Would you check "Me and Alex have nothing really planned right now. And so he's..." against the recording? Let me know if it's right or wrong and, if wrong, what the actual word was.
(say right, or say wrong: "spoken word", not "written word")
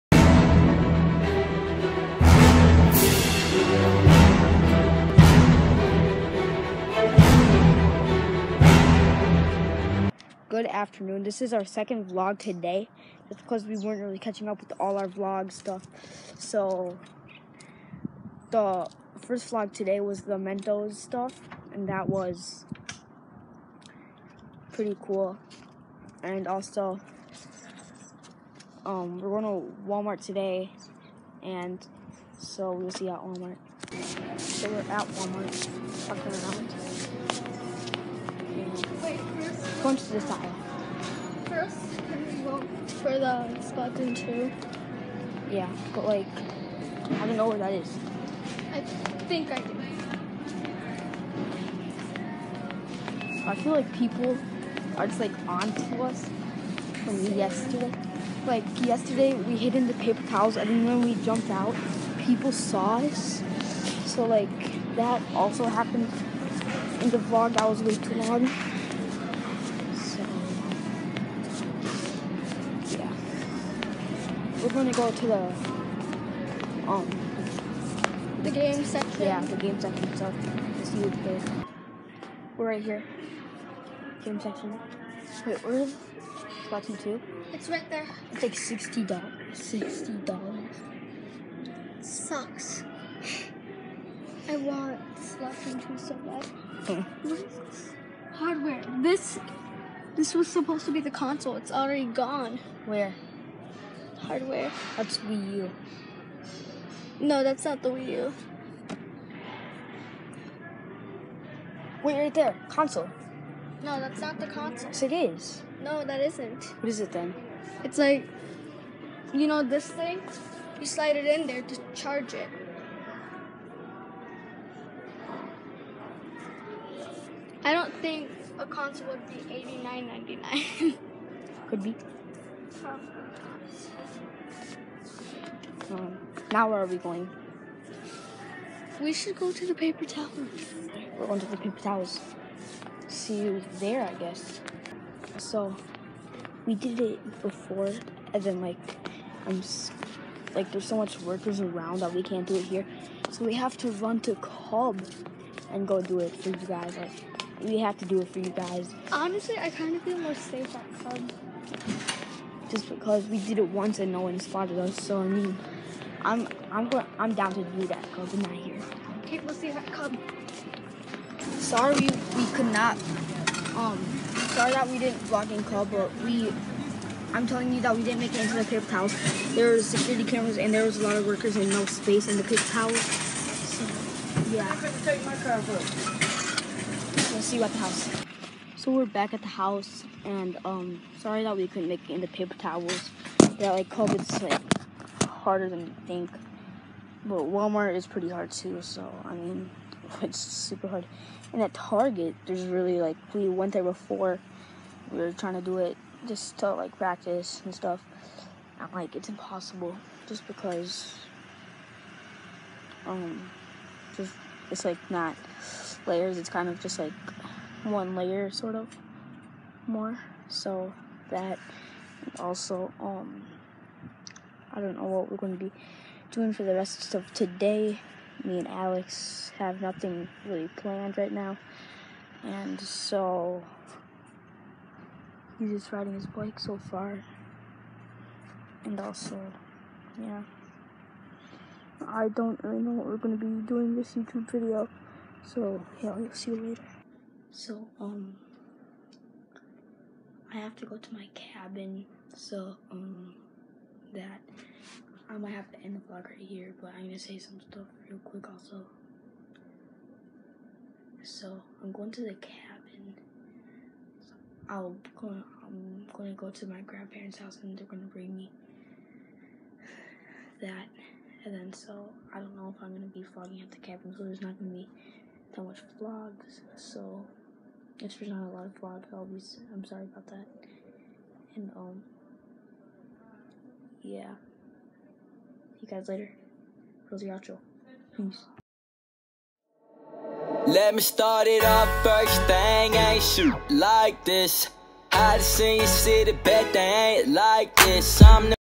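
right.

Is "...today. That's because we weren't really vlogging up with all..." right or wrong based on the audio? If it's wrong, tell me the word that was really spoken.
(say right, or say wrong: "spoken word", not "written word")
wrong: "catching", not "vlogging".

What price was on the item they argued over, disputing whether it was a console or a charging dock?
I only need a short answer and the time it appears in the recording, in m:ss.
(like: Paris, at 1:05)
89.99, at 2:09.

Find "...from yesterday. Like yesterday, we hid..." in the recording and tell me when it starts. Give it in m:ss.
0:57.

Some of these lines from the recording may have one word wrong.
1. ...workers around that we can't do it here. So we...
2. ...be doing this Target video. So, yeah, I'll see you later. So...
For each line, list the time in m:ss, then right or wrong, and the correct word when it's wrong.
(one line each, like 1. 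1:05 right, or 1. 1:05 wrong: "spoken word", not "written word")
1. 2:31 right
2. 4:03 wrong: "YouTube", not "Target".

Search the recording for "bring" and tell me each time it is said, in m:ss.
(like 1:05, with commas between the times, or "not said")
4:28.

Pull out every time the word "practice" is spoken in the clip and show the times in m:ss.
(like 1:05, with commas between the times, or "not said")
3:26.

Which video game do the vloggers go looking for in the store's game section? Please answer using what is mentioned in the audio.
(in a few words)
Splatoon 2.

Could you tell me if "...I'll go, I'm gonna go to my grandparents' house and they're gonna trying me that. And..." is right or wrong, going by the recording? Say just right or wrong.
wrong.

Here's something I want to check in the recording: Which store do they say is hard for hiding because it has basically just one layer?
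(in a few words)
Target.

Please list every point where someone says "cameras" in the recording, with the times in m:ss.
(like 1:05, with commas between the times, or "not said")
3:00.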